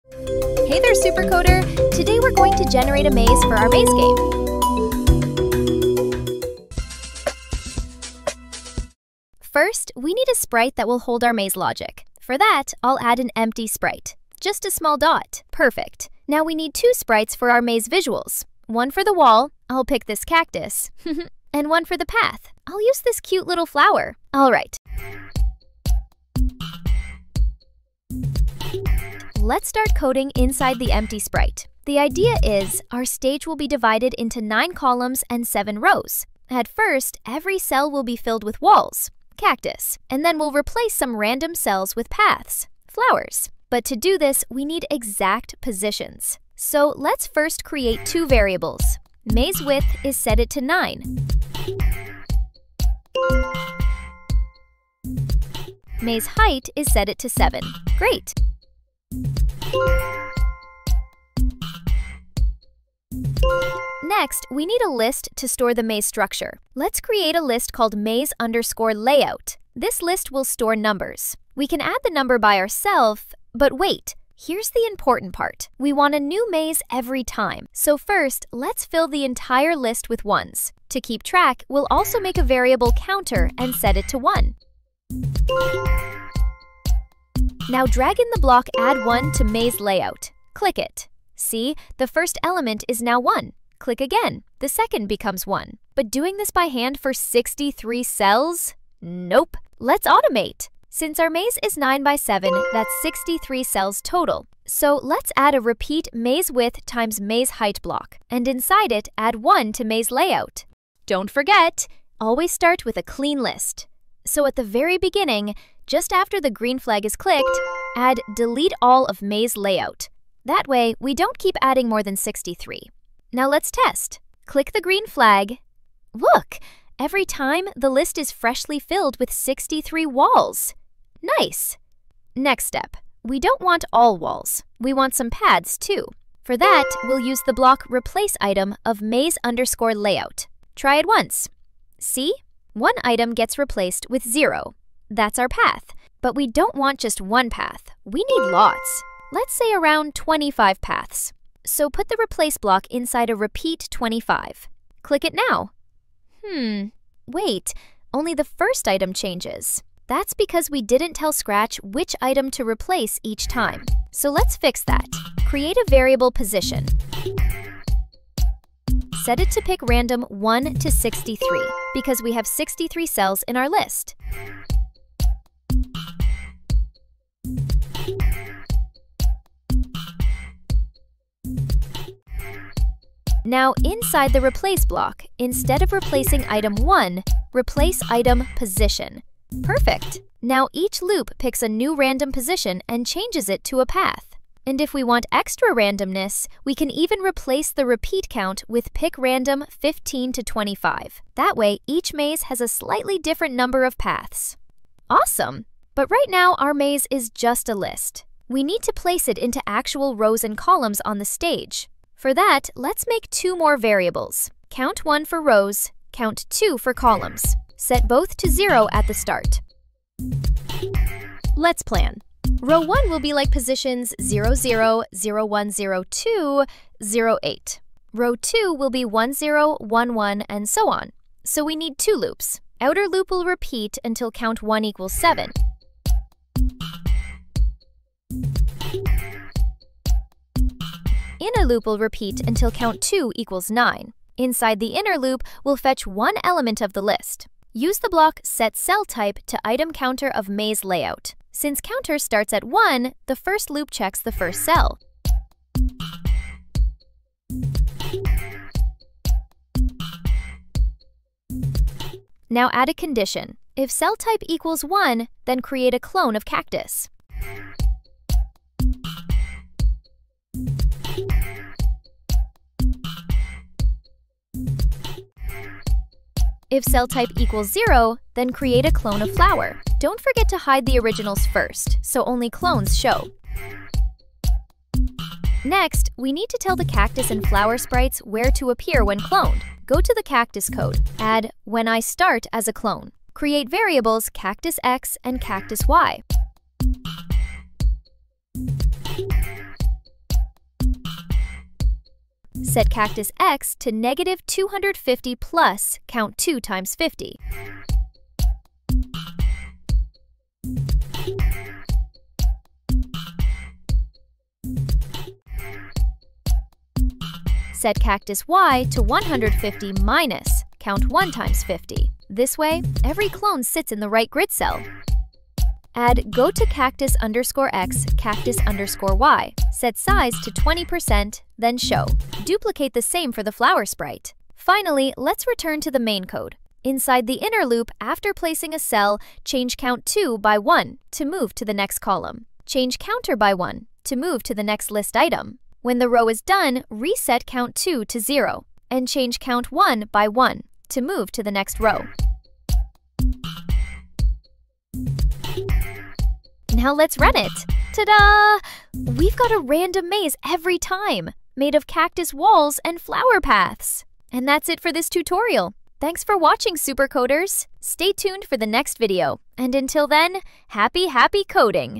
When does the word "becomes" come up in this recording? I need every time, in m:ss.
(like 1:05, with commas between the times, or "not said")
1:35.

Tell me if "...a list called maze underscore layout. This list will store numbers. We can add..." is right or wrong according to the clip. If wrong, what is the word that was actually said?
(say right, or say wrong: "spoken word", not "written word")
right.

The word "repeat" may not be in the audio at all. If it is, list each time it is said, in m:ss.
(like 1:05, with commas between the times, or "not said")
1:45, 2:33, 3:17, 3:53, 4:01.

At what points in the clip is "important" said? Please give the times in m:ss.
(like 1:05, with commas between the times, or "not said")
1:14.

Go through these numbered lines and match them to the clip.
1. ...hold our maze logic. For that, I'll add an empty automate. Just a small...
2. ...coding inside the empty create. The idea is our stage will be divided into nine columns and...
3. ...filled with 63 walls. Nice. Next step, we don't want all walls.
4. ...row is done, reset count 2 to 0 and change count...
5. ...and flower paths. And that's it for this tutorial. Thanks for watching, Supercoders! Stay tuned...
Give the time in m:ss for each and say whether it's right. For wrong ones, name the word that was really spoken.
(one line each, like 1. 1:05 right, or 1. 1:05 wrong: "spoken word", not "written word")
1. 0:10 wrong: "sprite", not "automate"
2. 0:29 wrong: "sprite", not "create"
3. 2:08 right
4. 5:46 right
5. 6:02 right.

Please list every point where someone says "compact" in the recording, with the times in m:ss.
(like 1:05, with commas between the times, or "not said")
not said.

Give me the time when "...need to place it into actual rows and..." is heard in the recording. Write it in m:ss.
3:28.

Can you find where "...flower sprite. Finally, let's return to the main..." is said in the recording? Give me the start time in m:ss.
5:33.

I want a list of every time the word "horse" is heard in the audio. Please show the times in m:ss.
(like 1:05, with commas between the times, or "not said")
not said.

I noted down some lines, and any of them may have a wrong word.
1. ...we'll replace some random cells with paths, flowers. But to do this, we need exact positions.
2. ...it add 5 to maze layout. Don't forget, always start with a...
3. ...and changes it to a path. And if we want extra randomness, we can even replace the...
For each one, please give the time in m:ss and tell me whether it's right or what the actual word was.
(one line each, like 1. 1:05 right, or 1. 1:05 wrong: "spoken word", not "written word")
1. 0:40 right
2. 1:48 wrong: "1", not "5"
3. 3:12 right.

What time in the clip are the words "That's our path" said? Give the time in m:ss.
2:25.